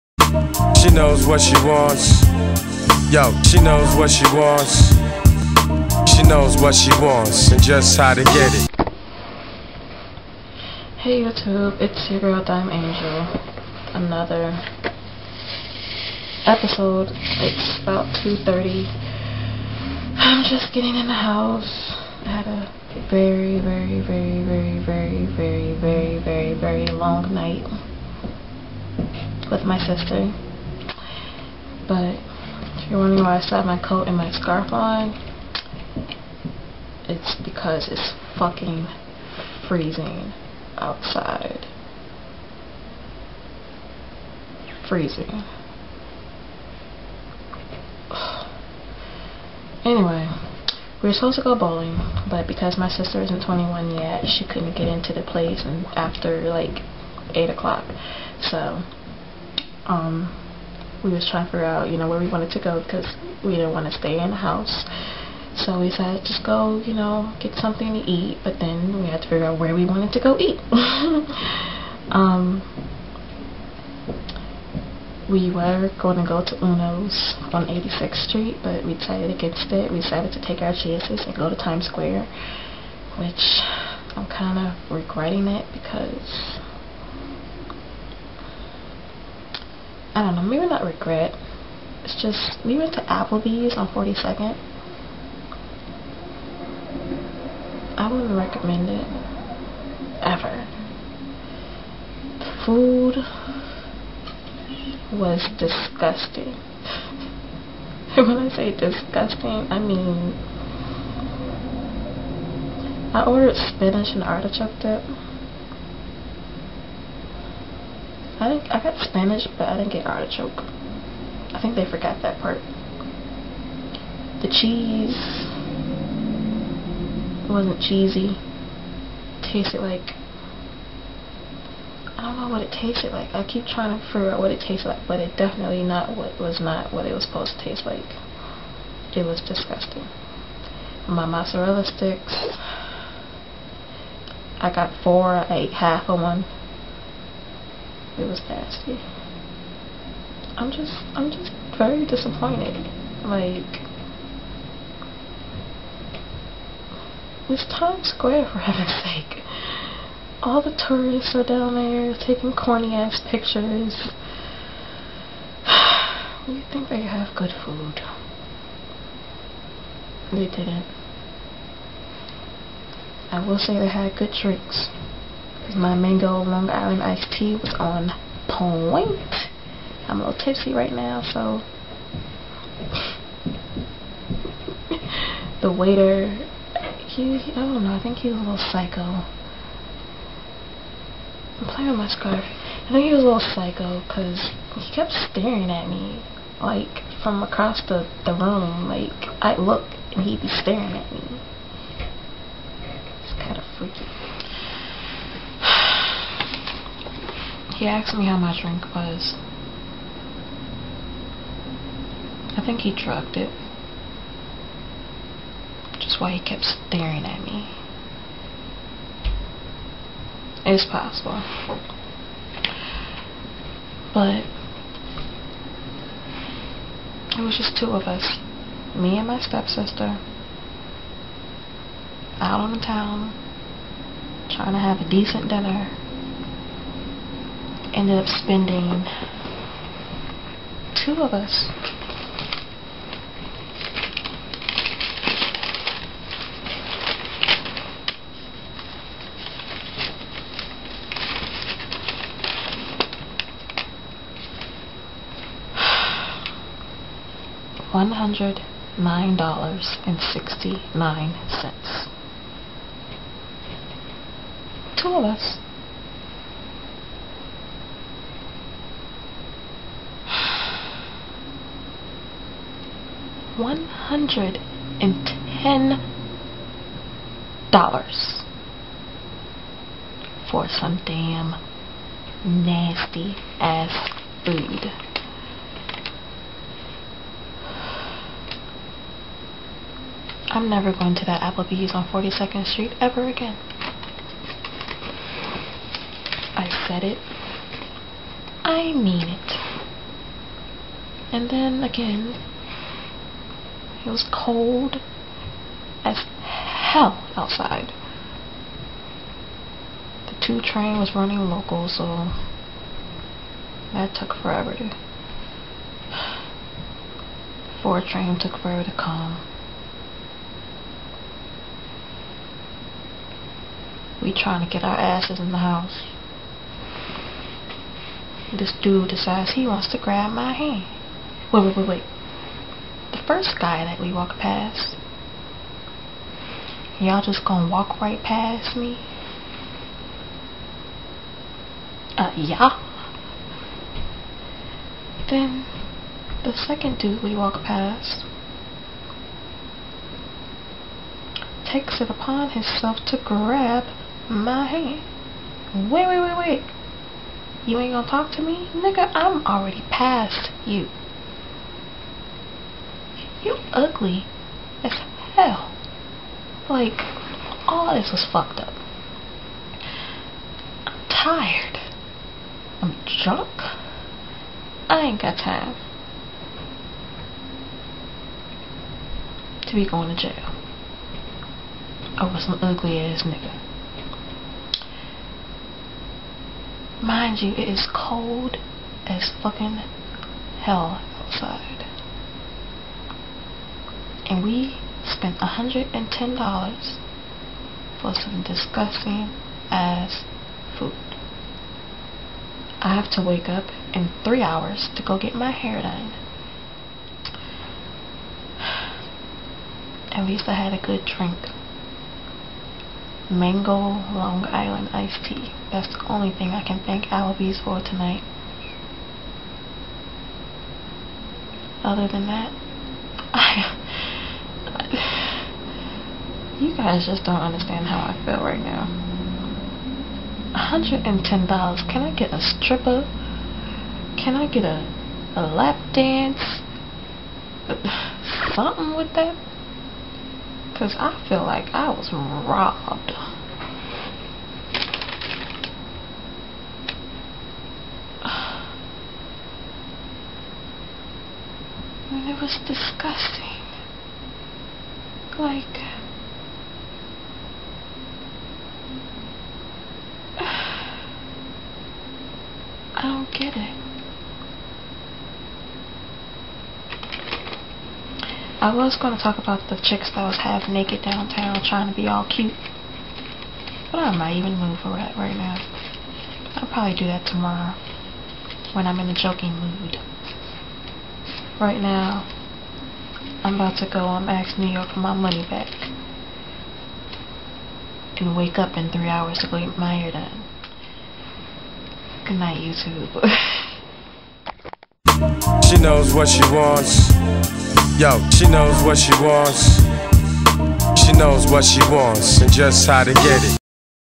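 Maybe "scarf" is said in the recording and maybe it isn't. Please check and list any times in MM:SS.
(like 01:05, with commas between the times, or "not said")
00:34, 03:12.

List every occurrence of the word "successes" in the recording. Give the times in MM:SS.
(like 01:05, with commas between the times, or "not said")
not said.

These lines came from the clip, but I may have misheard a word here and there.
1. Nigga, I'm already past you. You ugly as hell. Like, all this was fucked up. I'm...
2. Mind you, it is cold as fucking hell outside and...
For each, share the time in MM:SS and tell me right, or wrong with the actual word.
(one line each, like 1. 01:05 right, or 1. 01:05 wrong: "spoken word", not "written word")
1. 05:58 right
2. 06:27 right.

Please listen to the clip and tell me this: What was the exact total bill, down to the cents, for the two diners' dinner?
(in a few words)
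$109.69.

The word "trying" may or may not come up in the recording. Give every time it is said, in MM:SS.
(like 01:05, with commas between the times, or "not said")
01:01, 02:13, 03:54, 05:24, 07:51.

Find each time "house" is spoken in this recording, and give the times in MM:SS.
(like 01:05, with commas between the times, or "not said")
00:21, 01:04, 05:25.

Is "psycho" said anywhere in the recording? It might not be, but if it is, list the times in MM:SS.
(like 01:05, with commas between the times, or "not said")
03:08, 03:13.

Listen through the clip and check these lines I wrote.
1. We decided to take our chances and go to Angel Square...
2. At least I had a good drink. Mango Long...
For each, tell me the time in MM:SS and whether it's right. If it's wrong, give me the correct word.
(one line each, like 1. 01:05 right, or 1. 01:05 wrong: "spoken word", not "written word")
1. 01:19 wrong: "Times", not "Angel"
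2. 06:50 right.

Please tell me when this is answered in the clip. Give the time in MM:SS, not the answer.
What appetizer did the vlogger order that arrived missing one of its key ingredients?
01:53.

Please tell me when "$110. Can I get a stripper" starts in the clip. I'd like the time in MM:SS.
07:10.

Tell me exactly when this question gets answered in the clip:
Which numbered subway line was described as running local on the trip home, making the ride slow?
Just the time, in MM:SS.
05:10.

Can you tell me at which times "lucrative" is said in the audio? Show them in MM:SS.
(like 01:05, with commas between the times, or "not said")
not said.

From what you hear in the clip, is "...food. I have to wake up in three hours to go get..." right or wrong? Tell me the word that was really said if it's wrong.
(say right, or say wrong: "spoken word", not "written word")
right.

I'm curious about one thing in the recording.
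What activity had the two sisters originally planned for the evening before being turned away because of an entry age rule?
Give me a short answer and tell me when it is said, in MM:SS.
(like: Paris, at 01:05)
Bowling, at 00:51.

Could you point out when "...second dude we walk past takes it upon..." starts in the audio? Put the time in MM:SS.
05:46.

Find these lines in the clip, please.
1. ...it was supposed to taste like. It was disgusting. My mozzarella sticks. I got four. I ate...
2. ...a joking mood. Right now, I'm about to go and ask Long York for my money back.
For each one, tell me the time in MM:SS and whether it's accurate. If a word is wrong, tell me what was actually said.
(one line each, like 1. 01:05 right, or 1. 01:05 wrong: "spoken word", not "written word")
1. 02:17 right
2. 07:59 wrong: "New", not "Long".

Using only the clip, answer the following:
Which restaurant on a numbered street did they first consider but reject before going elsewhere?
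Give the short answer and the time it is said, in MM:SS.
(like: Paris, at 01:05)
Uno's on 86th Street, at 01:16.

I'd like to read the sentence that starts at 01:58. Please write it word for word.
I, I got Spanish, but I didn't get artichoke.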